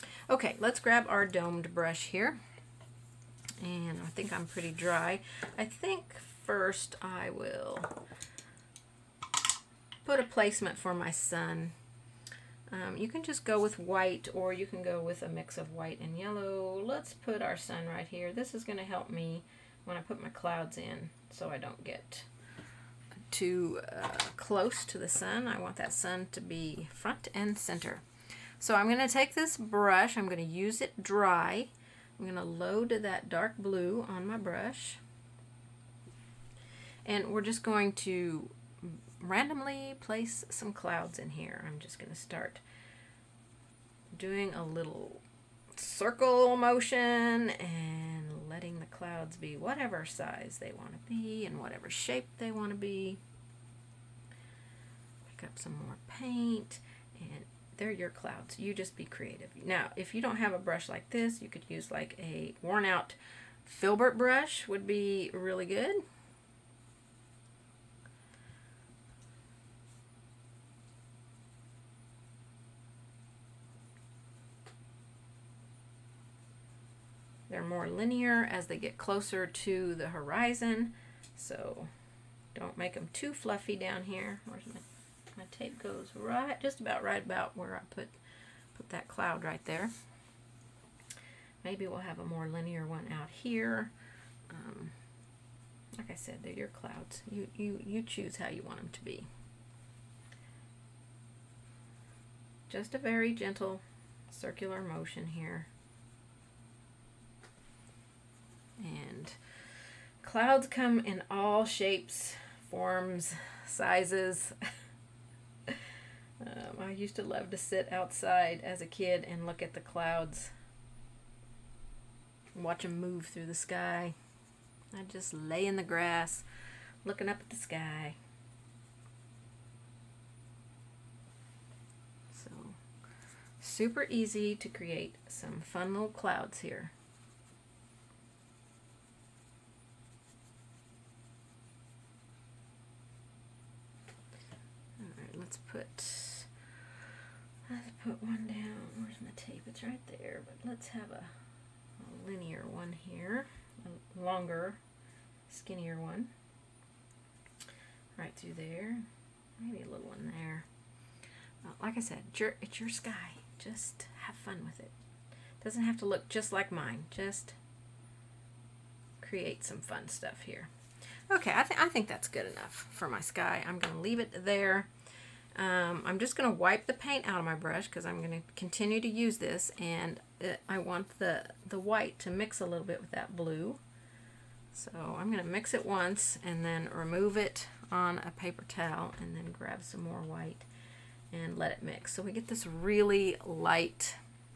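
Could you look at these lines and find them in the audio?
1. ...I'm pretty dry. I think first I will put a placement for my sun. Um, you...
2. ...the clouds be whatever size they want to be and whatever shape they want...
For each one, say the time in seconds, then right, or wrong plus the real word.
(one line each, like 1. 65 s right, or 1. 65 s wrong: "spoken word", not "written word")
1. 4 s right
2. 48 s right.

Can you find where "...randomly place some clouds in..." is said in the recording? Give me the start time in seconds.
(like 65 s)
39 s.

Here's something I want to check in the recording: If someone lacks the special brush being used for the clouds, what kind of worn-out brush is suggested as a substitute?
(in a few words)
Filbert brush.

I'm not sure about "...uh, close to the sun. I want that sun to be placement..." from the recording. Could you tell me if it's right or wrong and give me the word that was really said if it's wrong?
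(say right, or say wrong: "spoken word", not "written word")
wrong: "front", not "placement".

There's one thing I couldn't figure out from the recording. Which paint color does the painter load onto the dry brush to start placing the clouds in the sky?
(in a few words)
Dark blue.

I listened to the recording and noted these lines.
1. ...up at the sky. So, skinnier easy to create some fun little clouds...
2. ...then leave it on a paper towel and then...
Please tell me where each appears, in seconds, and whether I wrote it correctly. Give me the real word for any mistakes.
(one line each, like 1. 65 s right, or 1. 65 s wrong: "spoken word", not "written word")
1. 127 s wrong: "super", not "skinnier"
2. 186 s wrong: "remove", not "leave".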